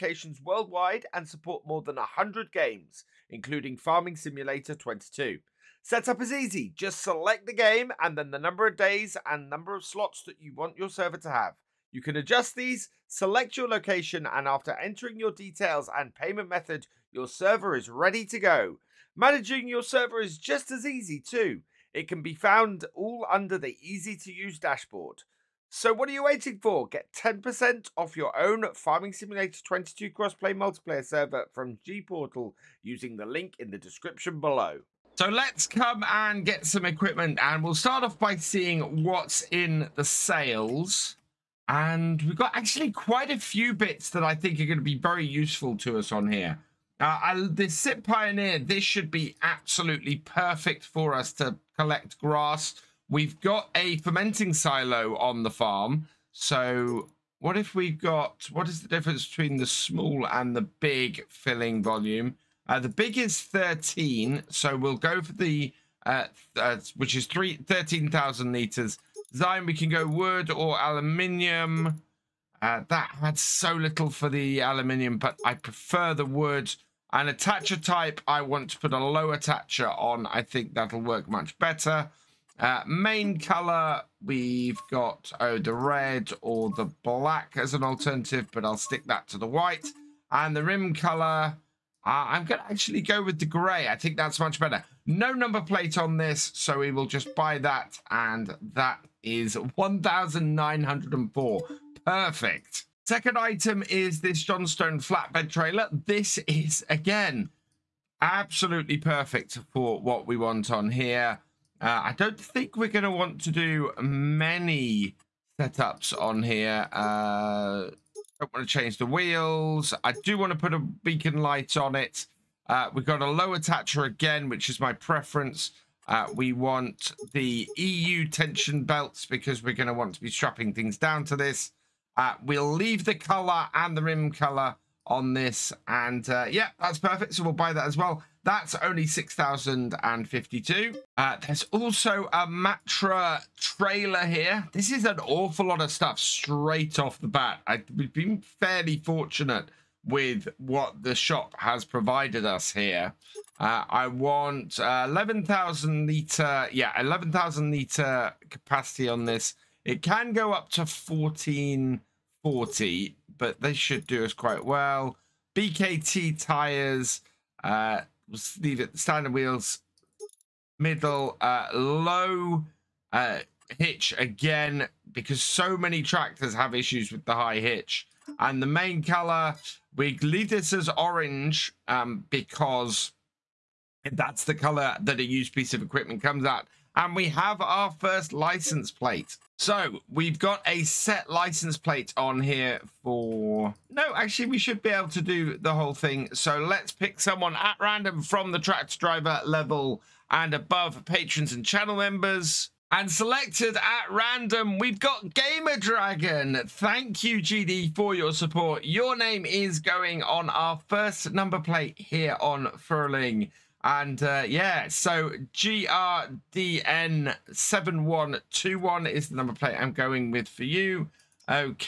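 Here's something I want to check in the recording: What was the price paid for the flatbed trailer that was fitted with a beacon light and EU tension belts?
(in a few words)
6,052.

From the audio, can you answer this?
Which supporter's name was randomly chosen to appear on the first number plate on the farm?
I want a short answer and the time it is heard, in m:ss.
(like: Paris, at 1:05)
Gamer Dragon, at 3:25.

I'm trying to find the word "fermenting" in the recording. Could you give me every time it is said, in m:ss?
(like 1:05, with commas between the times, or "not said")
0:53.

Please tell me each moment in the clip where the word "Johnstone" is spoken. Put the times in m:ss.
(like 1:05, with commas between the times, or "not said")
1:44.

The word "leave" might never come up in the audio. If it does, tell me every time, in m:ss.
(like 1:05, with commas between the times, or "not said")
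2:12, 2:48, 3:00.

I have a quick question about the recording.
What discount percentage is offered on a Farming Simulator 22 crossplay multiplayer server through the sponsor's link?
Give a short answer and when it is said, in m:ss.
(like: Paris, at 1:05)
10%, at 0:27.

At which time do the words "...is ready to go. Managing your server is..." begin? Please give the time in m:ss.
0:17.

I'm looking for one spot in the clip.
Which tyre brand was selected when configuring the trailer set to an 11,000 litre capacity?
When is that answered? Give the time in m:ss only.
2:45.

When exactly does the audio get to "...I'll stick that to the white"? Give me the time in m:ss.
1:28.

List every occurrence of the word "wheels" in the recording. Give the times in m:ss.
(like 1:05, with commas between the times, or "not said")
1:59, 2:49.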